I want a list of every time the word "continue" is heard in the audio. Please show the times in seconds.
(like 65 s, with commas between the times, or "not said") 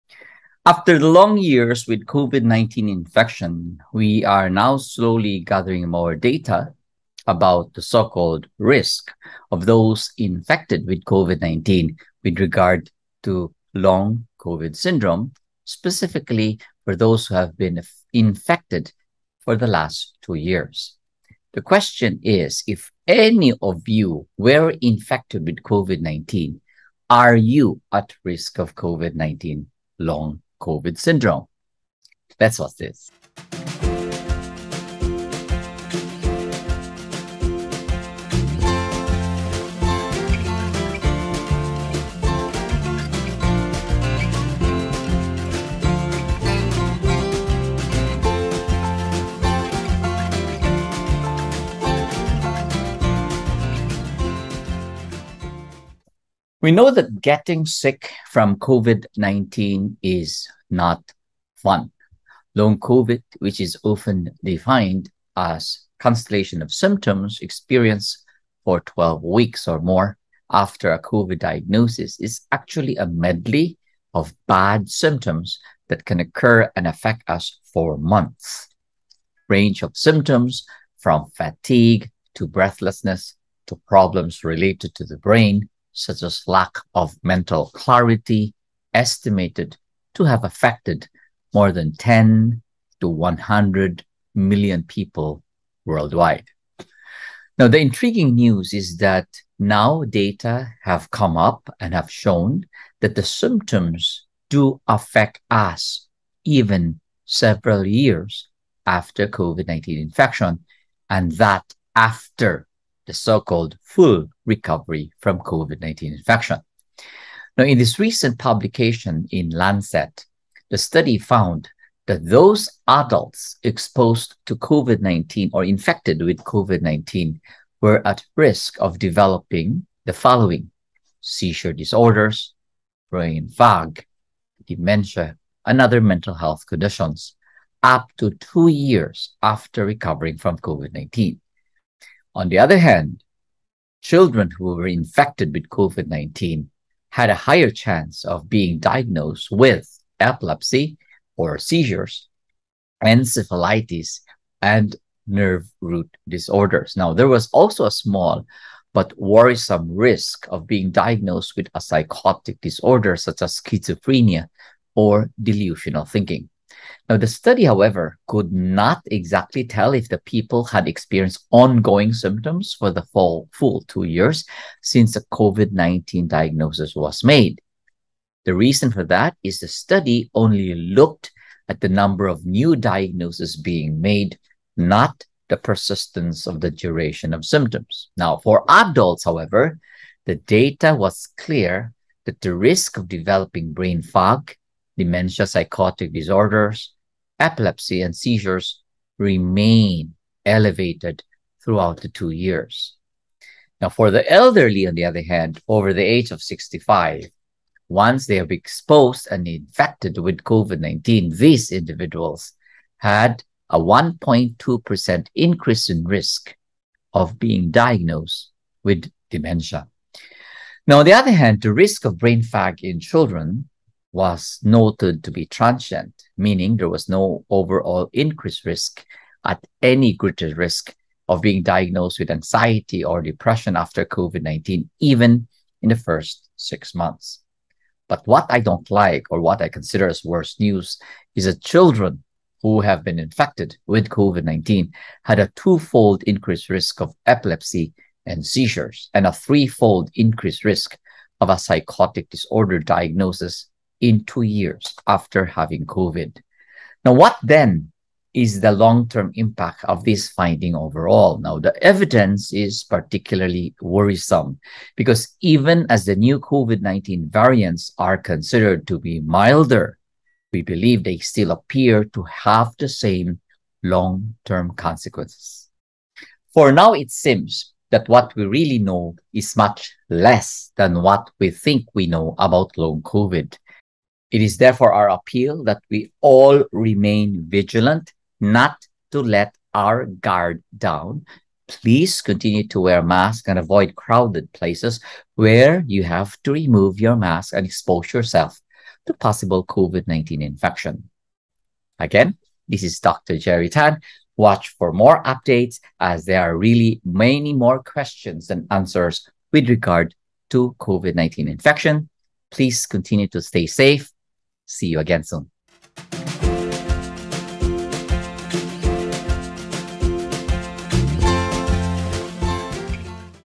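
292 s, 312 s.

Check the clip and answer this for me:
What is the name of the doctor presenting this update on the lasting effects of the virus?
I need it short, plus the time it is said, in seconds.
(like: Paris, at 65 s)
Gerry Tan, at 303 s.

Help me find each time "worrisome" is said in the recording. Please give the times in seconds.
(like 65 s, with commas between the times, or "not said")
159 s, 263 s.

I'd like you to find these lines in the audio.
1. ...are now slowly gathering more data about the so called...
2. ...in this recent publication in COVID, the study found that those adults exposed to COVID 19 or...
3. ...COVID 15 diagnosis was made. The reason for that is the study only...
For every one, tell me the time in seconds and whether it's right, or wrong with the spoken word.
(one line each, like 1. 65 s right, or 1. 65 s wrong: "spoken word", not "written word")
1. 4 s right
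2. 117 s wrong: "Lancet", not "COVID"
3. 175 s wrong: "19", not "15".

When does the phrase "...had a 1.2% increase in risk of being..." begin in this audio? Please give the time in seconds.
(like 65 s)
212 s.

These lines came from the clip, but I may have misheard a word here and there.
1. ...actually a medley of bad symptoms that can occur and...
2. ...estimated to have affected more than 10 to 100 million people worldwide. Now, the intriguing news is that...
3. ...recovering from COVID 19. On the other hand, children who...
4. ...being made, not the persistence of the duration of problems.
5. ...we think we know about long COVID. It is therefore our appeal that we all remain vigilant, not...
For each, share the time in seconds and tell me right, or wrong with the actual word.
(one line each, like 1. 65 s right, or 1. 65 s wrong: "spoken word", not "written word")
1. 72 s right
2. 88 s right
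3. 139 s right
4. 183 s wrong: "symptoms", not "problems"
5. 281 s right.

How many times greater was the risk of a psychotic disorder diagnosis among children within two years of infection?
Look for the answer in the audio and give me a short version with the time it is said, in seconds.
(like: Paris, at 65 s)
threefold, at 249 s.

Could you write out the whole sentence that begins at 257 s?
Now, what then is the long term impact of this finding overall?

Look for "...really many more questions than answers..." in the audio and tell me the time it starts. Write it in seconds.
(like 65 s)
306 s.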